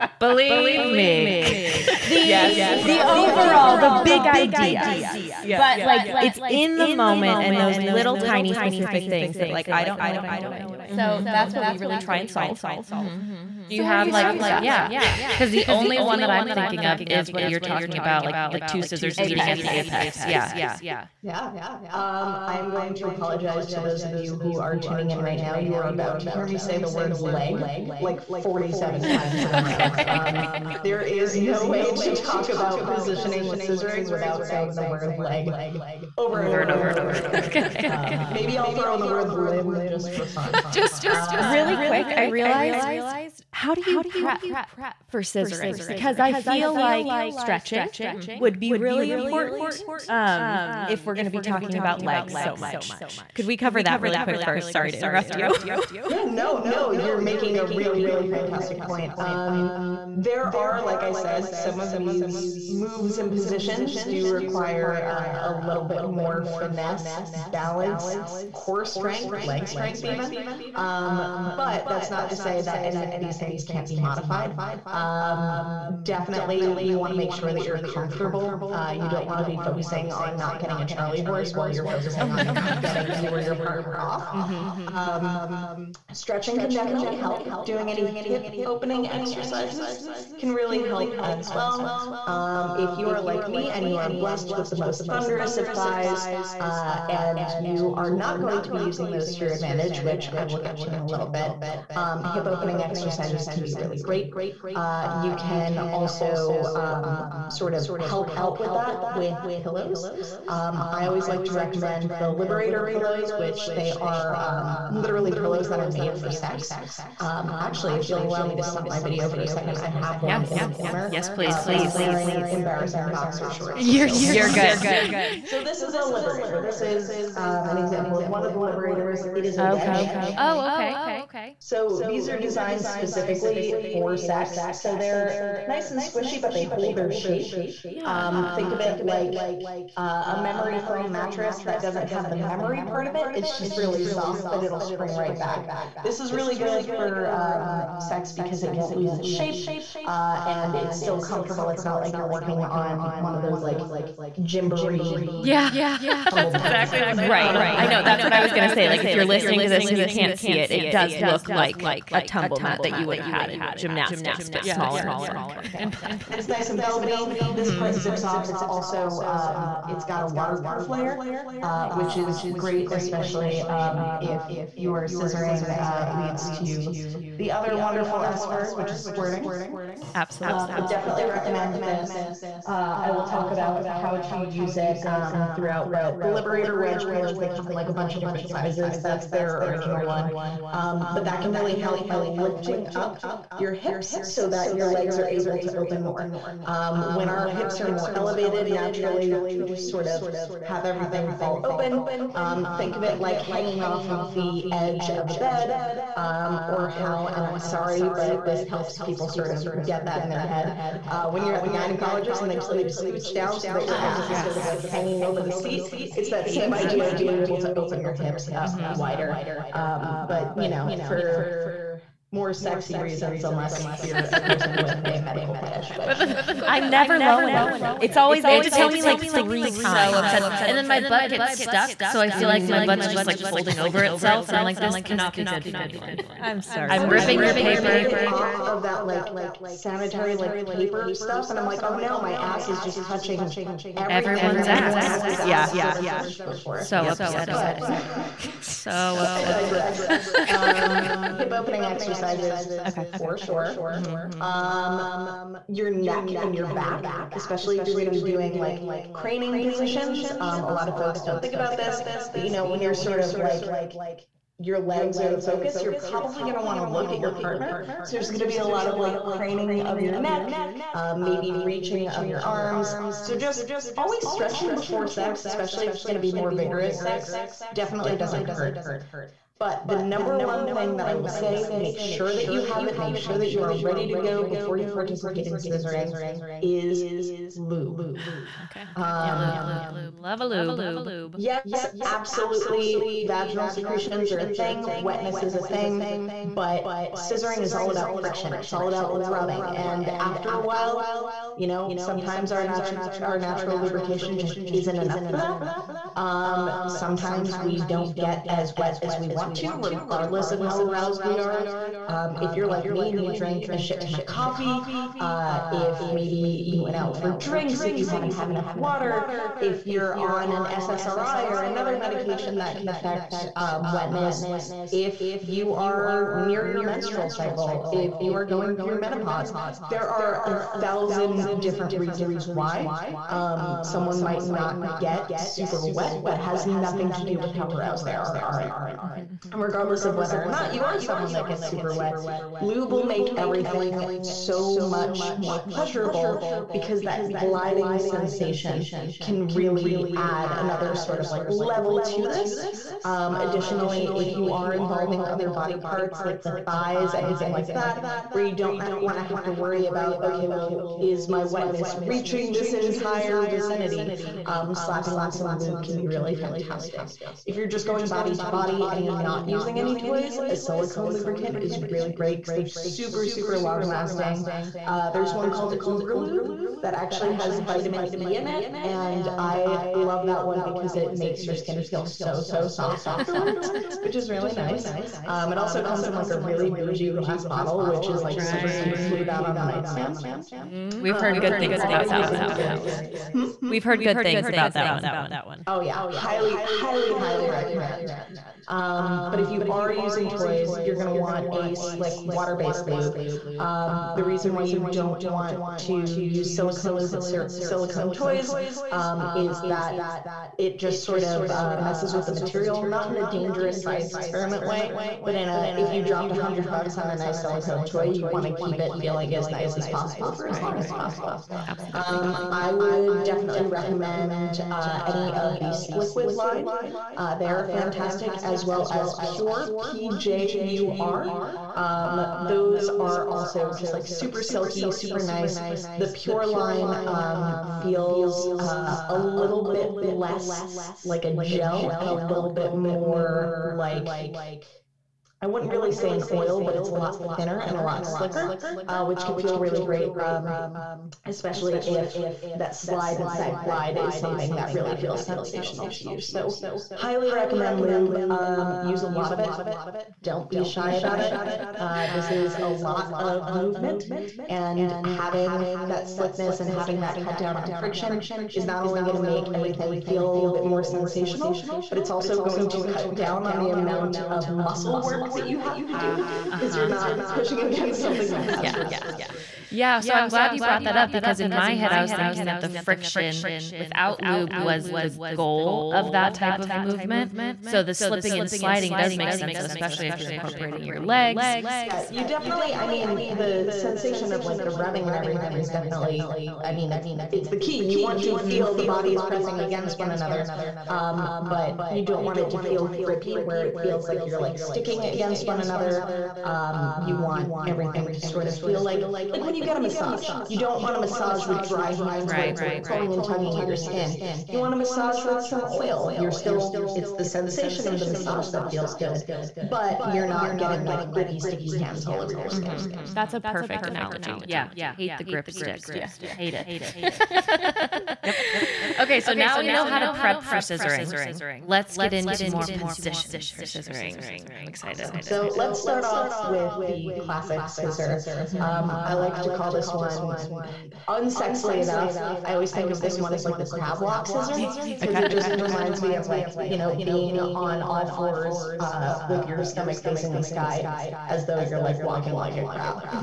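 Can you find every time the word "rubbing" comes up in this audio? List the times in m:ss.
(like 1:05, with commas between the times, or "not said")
4:59, 8:14.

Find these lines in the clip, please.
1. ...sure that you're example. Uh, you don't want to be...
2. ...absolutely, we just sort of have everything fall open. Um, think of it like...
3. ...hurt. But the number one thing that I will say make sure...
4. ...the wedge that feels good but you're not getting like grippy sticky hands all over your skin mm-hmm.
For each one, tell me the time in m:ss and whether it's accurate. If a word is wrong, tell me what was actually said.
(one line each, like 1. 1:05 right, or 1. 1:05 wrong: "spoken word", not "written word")
1. 1:17 wrong: "comfortable", not "example"
2. 3:18 wrong: "naturally", not "absolutely"
3. 4:38 right
4. 8:38 wrong: "massage", not "wedge".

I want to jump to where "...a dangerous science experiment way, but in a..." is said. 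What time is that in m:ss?
6:53.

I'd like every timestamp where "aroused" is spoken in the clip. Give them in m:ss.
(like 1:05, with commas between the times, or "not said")
5:10, 5:37.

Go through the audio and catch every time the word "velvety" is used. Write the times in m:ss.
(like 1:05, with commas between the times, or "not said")
2:46.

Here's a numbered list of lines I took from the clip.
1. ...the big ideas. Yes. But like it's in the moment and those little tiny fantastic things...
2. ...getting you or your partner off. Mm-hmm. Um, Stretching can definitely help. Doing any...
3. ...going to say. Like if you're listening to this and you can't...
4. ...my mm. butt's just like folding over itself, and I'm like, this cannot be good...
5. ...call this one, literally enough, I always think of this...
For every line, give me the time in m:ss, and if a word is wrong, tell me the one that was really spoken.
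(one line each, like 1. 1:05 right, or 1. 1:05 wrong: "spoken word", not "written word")
1. 0:03 wrong: "specific", not "fantastic"
2. 1:22 right
3. 2:38 right
4. 3:52 right
5. 8:59 wrong: "unsexily", not "literally".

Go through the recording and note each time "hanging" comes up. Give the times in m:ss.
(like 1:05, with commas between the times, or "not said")
3:23, 3:34.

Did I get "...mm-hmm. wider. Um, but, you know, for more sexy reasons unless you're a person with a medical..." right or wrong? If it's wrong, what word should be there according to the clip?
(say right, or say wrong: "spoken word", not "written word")
right.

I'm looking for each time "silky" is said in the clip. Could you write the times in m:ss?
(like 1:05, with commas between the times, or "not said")
7:14.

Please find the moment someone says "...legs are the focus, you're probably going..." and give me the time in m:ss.
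4:24.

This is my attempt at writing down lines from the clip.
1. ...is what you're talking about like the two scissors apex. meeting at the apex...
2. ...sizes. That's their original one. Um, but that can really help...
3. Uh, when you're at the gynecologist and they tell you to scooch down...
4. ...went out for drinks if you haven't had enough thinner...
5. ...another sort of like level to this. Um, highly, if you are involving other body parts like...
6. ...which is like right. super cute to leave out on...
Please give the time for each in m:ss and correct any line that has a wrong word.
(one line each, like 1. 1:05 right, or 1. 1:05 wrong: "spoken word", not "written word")
1. 0:17 right
2. 3:08 right
3. 3:31 right
4. 5:16 wrong: "water", not "thinner"
5. 5:50 wrong: "additionally", not "highly"
6. 6:27 right.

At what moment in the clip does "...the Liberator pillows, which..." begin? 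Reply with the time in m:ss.
1:52.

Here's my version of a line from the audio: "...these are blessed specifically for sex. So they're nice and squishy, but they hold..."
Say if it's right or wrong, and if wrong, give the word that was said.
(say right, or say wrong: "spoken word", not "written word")
wrong: "designed", not "blessed".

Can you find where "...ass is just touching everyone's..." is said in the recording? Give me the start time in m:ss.
4:02.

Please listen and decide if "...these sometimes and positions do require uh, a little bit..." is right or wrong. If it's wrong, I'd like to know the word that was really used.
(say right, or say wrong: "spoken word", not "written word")
wrong: "moves", not "sometimes".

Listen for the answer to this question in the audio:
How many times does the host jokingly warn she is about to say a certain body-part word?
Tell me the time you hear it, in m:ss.
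0:28.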